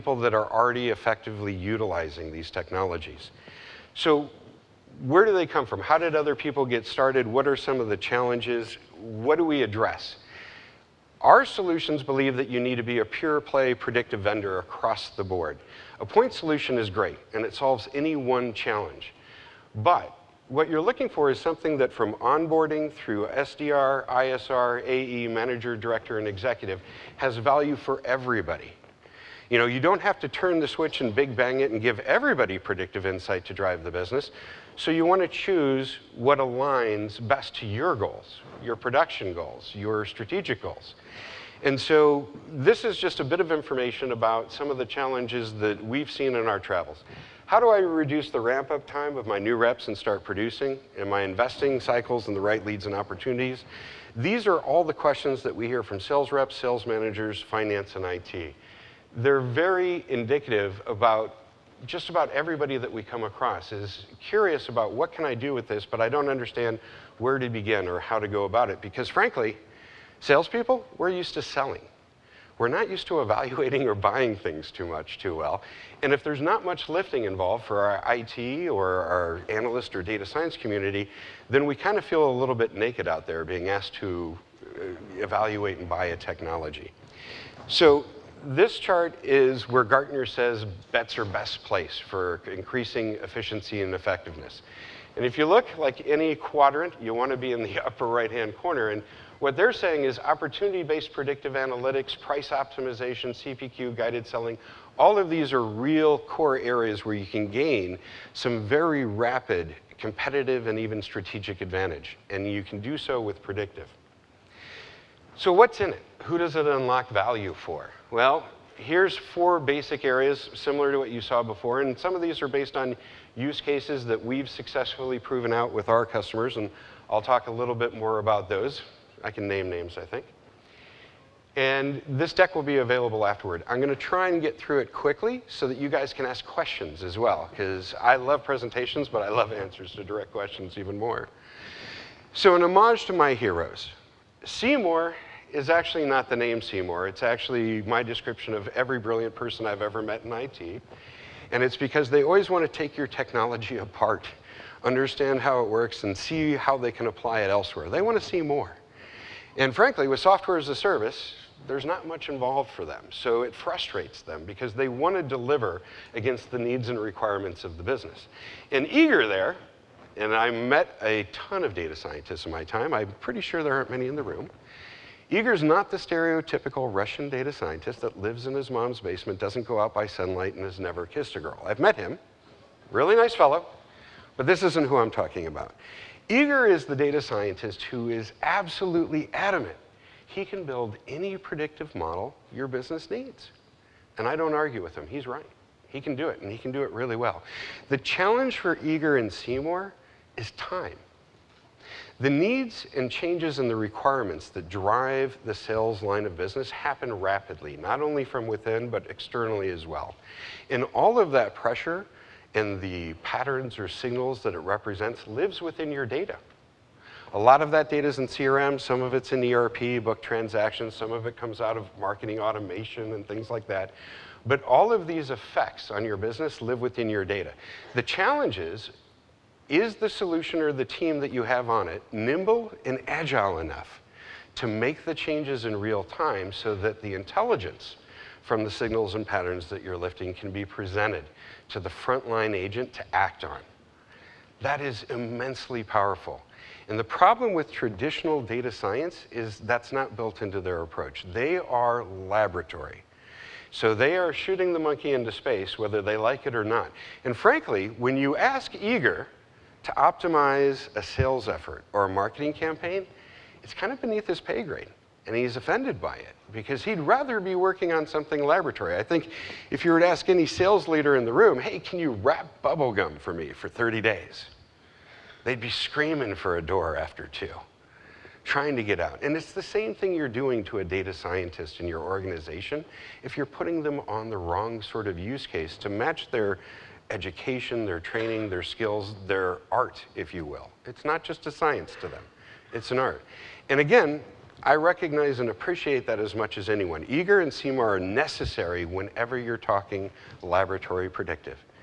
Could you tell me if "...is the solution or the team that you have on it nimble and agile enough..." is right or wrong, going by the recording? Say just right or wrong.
right.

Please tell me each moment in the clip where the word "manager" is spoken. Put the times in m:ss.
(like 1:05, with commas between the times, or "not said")
0:25, 0:56.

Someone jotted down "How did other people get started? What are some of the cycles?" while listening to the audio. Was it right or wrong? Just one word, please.
wrong.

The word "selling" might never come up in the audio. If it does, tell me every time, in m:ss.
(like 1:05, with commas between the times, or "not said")
1:11, 1:44.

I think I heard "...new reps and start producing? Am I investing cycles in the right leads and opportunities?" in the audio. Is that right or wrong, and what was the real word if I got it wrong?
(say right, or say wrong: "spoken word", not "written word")
right.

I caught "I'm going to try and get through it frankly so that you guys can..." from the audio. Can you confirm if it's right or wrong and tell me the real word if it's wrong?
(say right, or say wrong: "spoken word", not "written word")
wrong: "quickly", not "frankly".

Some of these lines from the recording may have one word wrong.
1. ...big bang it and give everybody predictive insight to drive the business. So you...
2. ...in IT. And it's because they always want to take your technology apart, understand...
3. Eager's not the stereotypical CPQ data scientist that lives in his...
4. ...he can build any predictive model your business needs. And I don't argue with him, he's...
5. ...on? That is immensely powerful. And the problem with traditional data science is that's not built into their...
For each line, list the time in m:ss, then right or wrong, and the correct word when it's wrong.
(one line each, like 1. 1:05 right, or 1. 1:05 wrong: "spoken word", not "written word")
1. 0:31 right
2. 2:30 right
3. 2:55 wrong: "Russian", not "CPQ"
4. 3:10 right
5. 4:03 right.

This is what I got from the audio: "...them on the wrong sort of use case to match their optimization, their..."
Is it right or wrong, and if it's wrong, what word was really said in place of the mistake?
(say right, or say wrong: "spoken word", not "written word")
wrong: "education", not "optimization".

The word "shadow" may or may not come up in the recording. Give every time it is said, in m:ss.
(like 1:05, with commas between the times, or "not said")
not said.